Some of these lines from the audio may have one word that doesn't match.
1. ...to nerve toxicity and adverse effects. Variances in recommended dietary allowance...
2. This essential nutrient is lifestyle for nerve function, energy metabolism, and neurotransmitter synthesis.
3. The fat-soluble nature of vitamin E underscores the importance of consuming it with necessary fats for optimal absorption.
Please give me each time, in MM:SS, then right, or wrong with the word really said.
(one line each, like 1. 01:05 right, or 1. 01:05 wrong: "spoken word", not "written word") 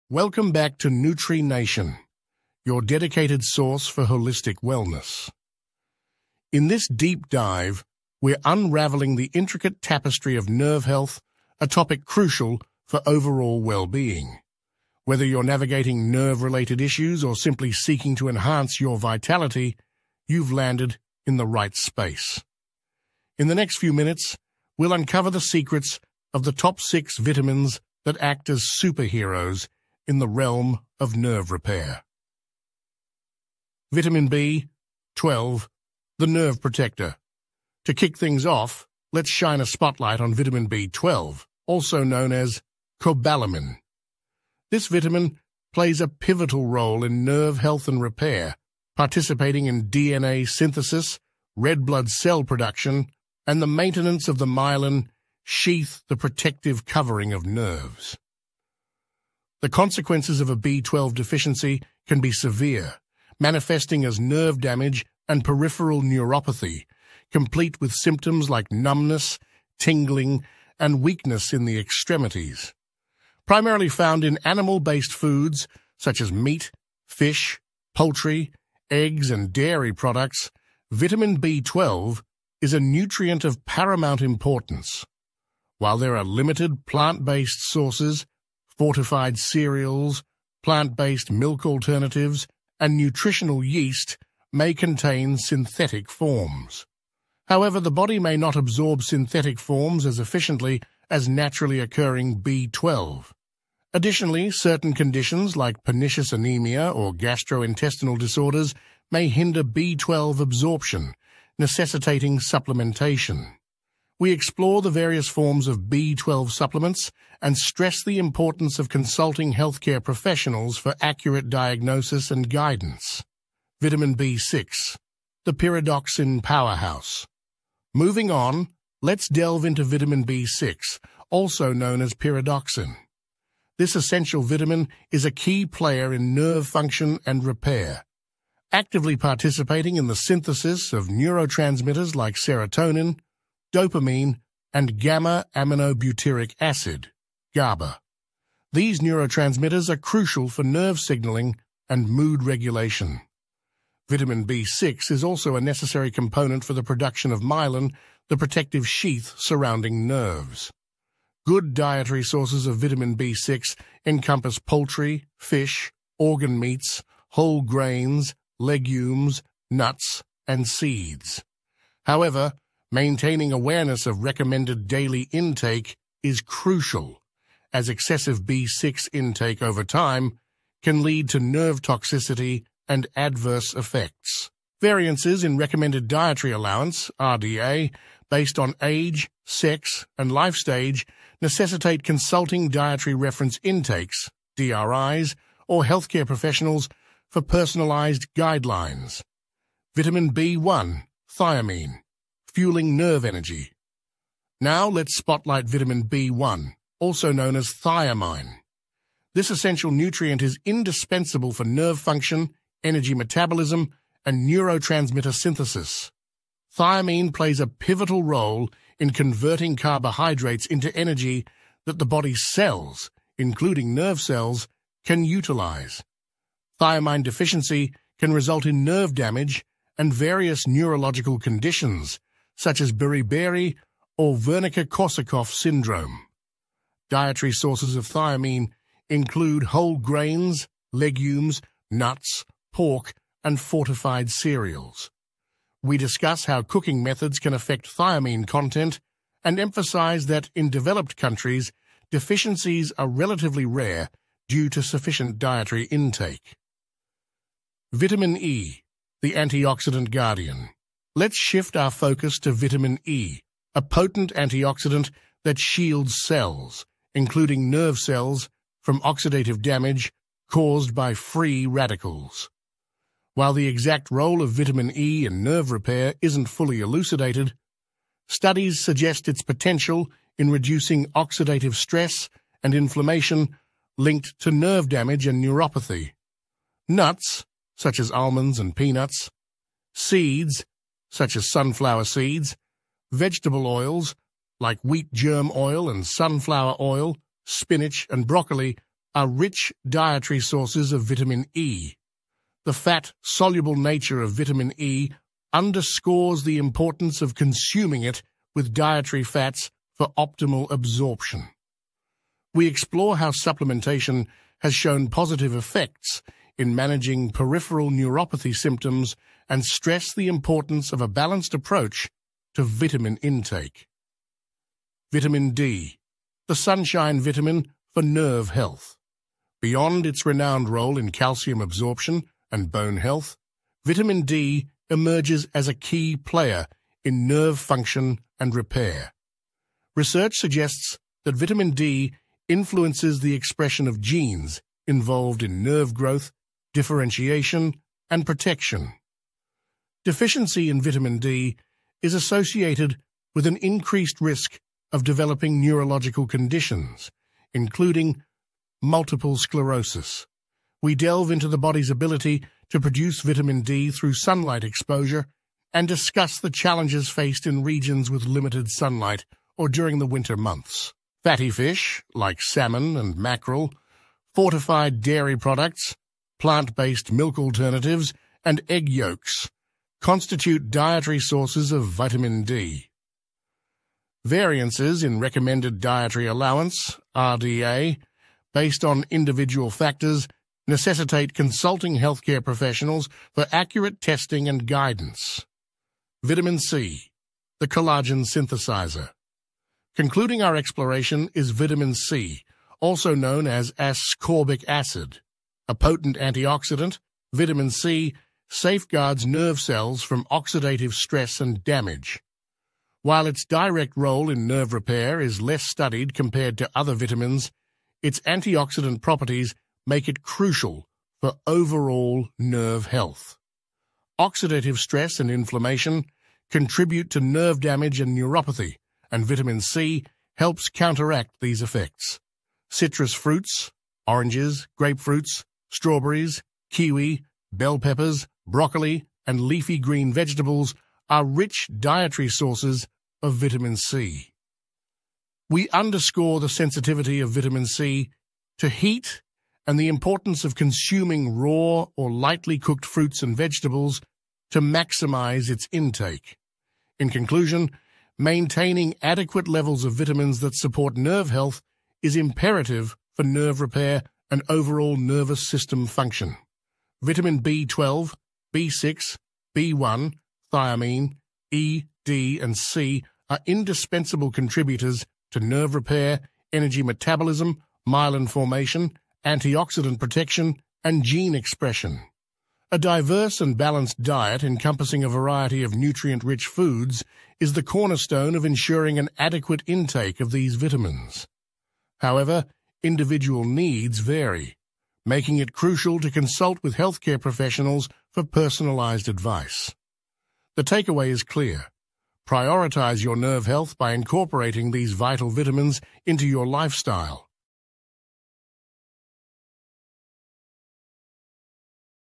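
1. 03:01 right
2. 03:29 wrong: "indispensable", not "lifestyle"
3. 05:02 wrong: "dietary", not "necessary".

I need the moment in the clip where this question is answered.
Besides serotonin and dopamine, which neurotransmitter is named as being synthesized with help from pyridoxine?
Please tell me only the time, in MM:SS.
02:24.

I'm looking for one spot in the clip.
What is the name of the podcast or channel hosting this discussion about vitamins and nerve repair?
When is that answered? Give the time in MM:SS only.
00:00.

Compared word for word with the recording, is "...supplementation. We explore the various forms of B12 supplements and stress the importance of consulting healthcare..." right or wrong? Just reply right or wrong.
right.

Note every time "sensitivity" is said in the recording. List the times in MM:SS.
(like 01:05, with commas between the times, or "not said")
07:26.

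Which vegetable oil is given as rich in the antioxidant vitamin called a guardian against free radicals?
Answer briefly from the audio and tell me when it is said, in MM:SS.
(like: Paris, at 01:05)
wheat germ oil, at 04:54.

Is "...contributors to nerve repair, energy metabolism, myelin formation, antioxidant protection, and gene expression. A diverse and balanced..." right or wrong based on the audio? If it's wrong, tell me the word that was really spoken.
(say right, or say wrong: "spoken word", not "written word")
right.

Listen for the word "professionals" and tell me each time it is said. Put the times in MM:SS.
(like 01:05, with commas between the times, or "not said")
02:00, 03:16, 06:32, 08:17.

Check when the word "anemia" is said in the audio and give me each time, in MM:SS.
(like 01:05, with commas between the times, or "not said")
01:46.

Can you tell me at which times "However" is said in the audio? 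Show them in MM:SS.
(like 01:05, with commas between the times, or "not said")
01:37, 02:52, 08:11.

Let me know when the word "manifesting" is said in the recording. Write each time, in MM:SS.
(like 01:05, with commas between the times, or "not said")
01:03.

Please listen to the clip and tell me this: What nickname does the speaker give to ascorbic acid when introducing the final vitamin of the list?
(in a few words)
the collagen synthesizer.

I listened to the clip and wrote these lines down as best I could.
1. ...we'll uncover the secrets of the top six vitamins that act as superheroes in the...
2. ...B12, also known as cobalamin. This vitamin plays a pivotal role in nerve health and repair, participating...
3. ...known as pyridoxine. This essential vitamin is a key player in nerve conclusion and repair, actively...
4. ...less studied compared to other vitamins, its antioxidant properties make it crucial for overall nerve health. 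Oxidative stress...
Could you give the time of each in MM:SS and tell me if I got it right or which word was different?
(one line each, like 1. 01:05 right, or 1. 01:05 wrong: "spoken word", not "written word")
1. 00:24 right
2. 00:40 right
3. 02:11 wrong: "function", not "conclusion"
4. 06:55 right.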